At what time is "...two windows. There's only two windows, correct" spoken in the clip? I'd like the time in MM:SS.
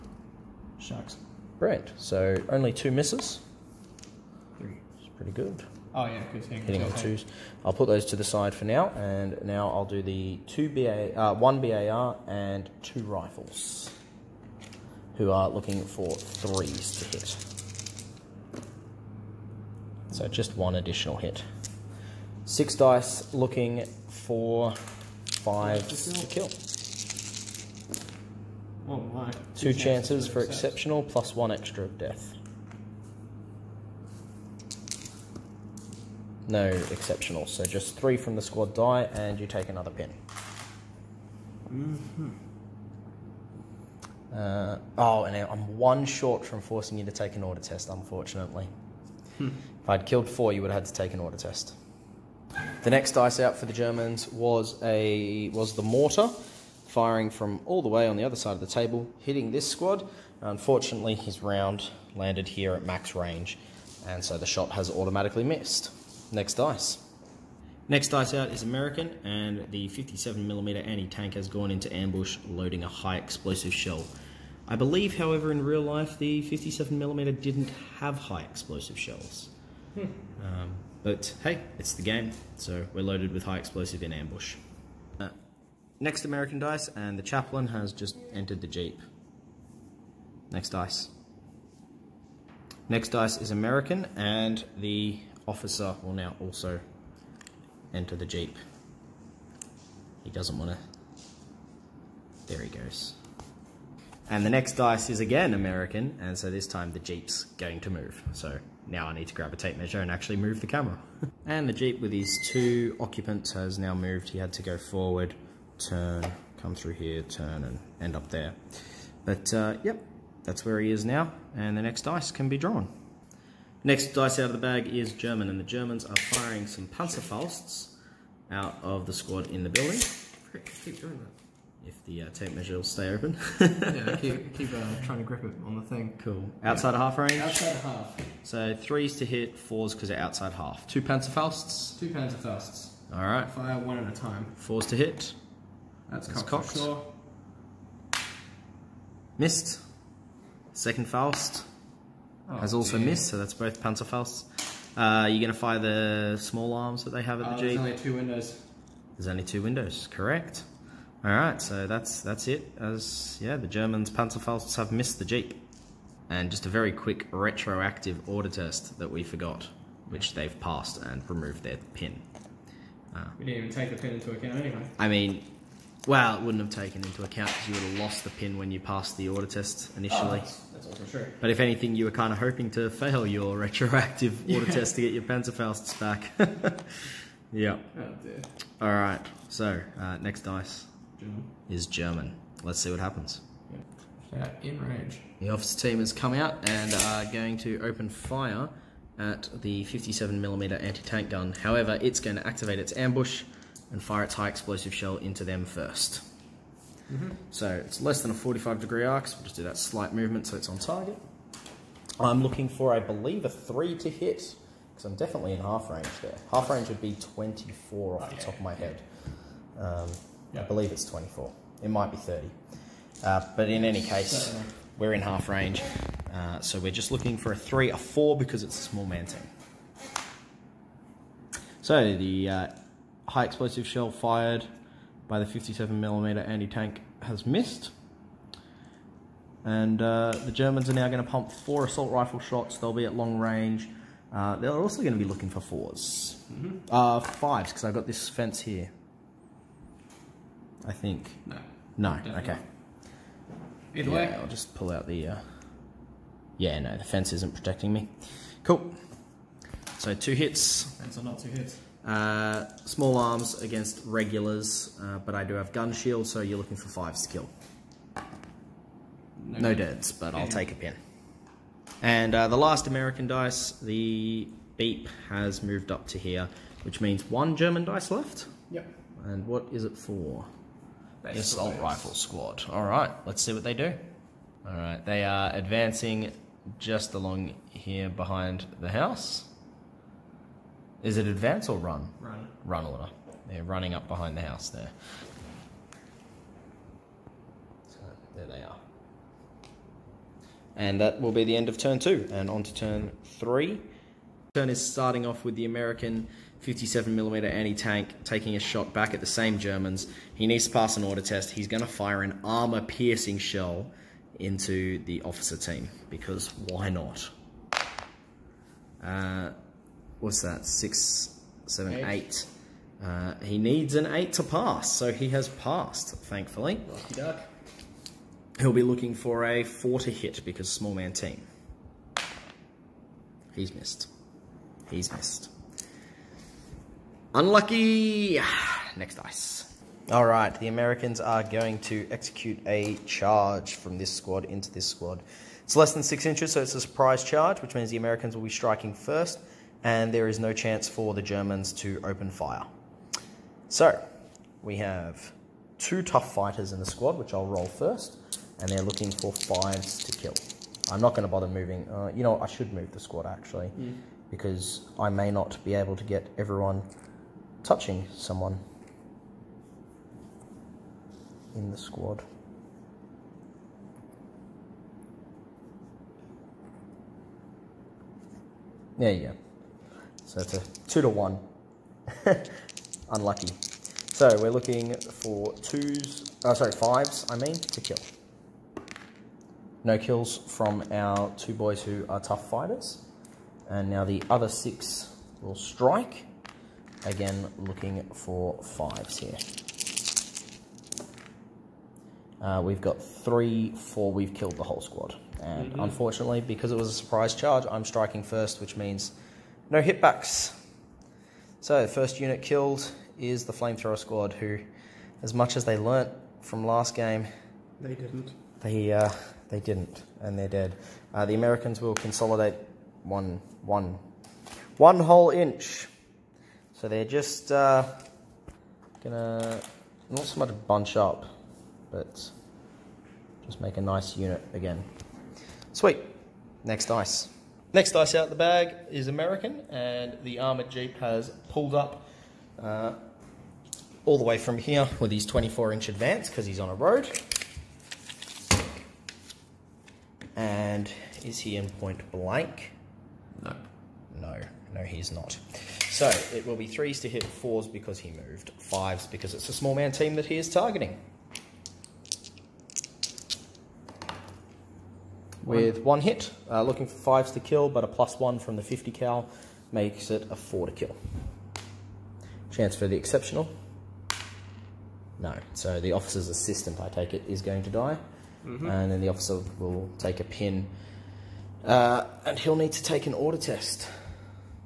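02:37.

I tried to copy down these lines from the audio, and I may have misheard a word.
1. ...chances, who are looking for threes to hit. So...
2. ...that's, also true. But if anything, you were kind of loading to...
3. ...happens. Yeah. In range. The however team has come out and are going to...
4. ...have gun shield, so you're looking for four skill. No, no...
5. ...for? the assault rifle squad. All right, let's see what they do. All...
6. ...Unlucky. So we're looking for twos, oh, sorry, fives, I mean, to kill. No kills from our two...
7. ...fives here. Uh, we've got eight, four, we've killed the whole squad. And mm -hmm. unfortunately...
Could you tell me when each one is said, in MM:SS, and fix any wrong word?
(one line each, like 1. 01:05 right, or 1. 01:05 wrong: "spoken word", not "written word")
1. 00:13 wrong: "rifles", not "chances"
2. 03:00 wrong: "hoping", not "loading"
3. 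03:12 wrong: "officer", not "however"
4. 04:25 wrong: "five", not "four"
5. 04:39 right
6. 06:23 right
7. 06:38 wrong: "three", not "eight".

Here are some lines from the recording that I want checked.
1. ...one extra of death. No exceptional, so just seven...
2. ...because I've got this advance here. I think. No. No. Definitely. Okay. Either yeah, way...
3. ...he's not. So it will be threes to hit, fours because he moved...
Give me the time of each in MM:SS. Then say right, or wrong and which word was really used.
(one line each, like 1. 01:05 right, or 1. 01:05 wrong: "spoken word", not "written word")
1. 00:31 wrong: "three", not "seven"
2. 04:07 wrong: "fence", not "advance"
3. 07:34 right.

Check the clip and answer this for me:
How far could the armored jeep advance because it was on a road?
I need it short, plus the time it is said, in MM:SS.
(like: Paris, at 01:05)
24 inches, at 07:25.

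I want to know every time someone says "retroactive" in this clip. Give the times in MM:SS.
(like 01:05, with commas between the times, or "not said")
02:47, 03:03.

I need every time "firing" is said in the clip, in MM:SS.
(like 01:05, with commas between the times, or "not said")
00:56, 02:06.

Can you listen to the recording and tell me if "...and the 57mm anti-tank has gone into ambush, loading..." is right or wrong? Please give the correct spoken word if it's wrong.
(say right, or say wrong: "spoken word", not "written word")
right.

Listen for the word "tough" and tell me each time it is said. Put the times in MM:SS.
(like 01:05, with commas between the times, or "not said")
05:56, 06:32.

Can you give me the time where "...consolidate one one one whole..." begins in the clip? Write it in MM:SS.
07:02.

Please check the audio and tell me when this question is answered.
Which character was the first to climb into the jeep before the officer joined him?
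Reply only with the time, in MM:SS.
01:27.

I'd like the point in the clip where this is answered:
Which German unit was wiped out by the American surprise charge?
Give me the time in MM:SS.
06:53.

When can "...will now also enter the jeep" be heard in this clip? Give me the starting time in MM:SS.
01:36.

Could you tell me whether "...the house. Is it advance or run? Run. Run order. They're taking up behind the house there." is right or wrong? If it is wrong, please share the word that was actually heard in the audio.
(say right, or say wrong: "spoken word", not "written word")
wrong: "running", not "taking".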